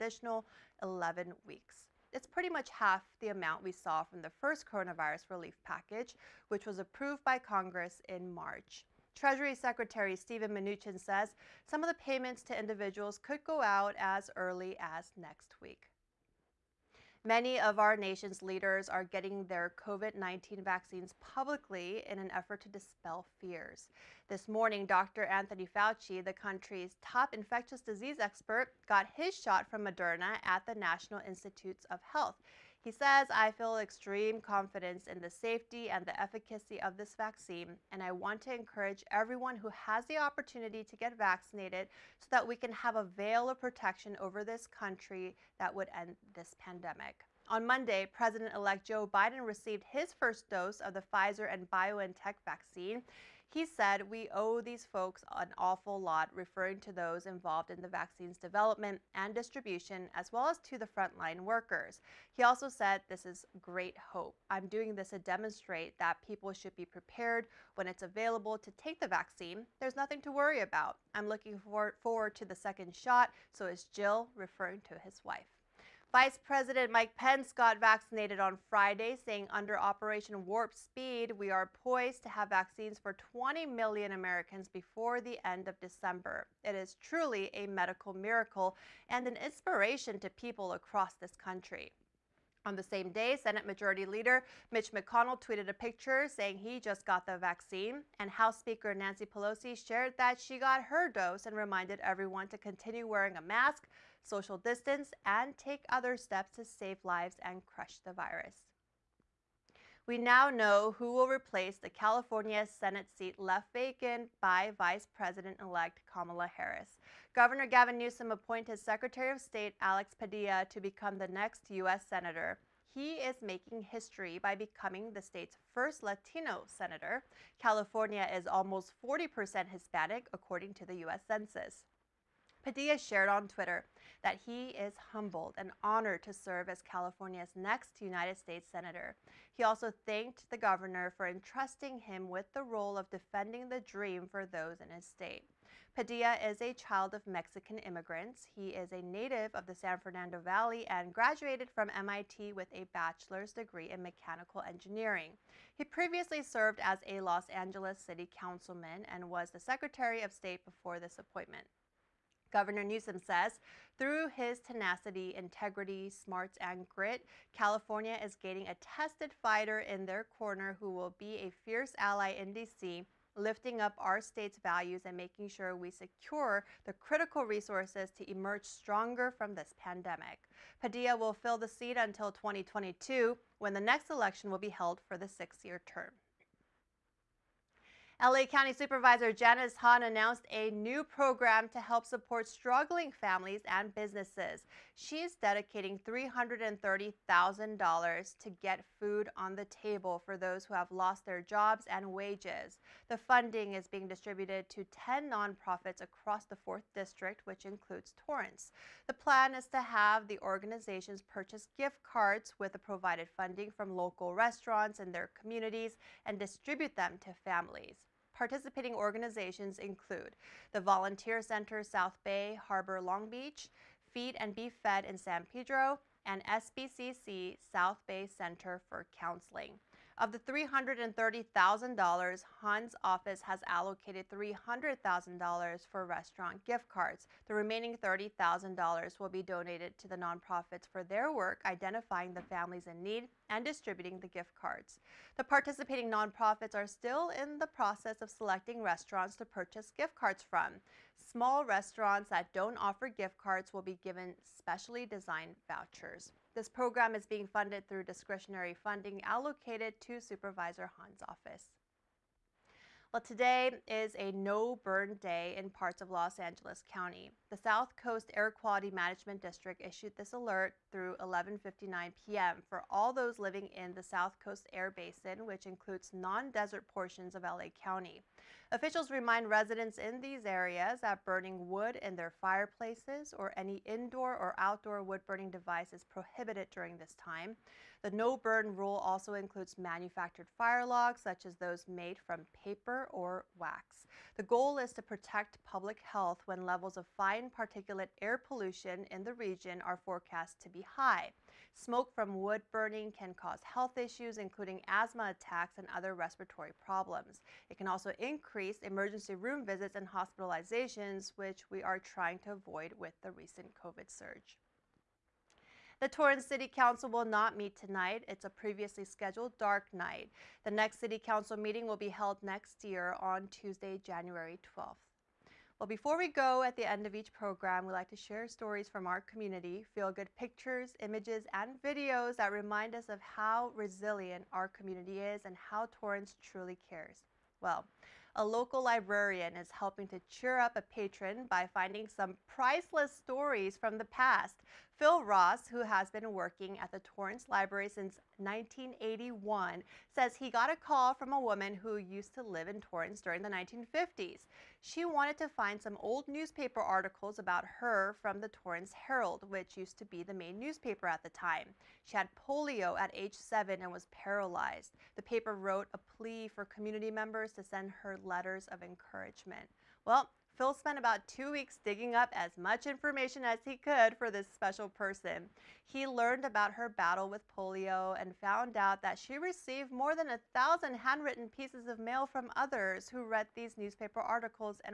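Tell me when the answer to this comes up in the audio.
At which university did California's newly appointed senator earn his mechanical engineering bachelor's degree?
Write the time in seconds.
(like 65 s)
151 s.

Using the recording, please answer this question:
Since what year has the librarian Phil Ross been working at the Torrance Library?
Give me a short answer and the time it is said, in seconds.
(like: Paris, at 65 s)
1981, at 348 s.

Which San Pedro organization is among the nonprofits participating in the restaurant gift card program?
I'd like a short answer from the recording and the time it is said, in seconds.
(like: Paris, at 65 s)
Feed and Be Fed, at 224 s.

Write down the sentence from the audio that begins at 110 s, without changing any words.
We now know who will replace the California Senate seat left vacant by Vice President elect Kamala Harris.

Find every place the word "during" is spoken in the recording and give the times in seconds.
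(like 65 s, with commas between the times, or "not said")
286 s, 353 s.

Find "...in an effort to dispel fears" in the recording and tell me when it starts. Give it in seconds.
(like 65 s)
22 s.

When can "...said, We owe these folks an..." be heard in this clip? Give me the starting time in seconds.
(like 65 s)
53 s.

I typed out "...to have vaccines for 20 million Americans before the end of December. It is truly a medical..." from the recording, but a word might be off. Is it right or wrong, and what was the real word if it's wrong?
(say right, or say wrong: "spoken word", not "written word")
right.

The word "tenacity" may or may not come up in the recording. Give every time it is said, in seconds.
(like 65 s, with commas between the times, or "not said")
164 s.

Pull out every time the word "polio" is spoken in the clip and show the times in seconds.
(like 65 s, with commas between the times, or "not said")
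362 s, 377 s.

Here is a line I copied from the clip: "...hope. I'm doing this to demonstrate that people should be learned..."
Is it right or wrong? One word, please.
wrong.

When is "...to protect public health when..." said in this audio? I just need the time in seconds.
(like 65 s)
294 s.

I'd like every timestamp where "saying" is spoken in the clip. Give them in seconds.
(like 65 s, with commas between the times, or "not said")
79 s, 96 s.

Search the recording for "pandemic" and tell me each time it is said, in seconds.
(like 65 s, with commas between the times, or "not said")
46 s, 179 s.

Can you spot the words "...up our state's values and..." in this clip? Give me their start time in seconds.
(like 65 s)
173 s.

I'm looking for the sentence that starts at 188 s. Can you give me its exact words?
LA County Supervisor Janice Hahn announced a new program to help support struggling families and businesses.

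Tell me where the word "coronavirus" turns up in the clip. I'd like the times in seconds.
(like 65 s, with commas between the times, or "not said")
4 s.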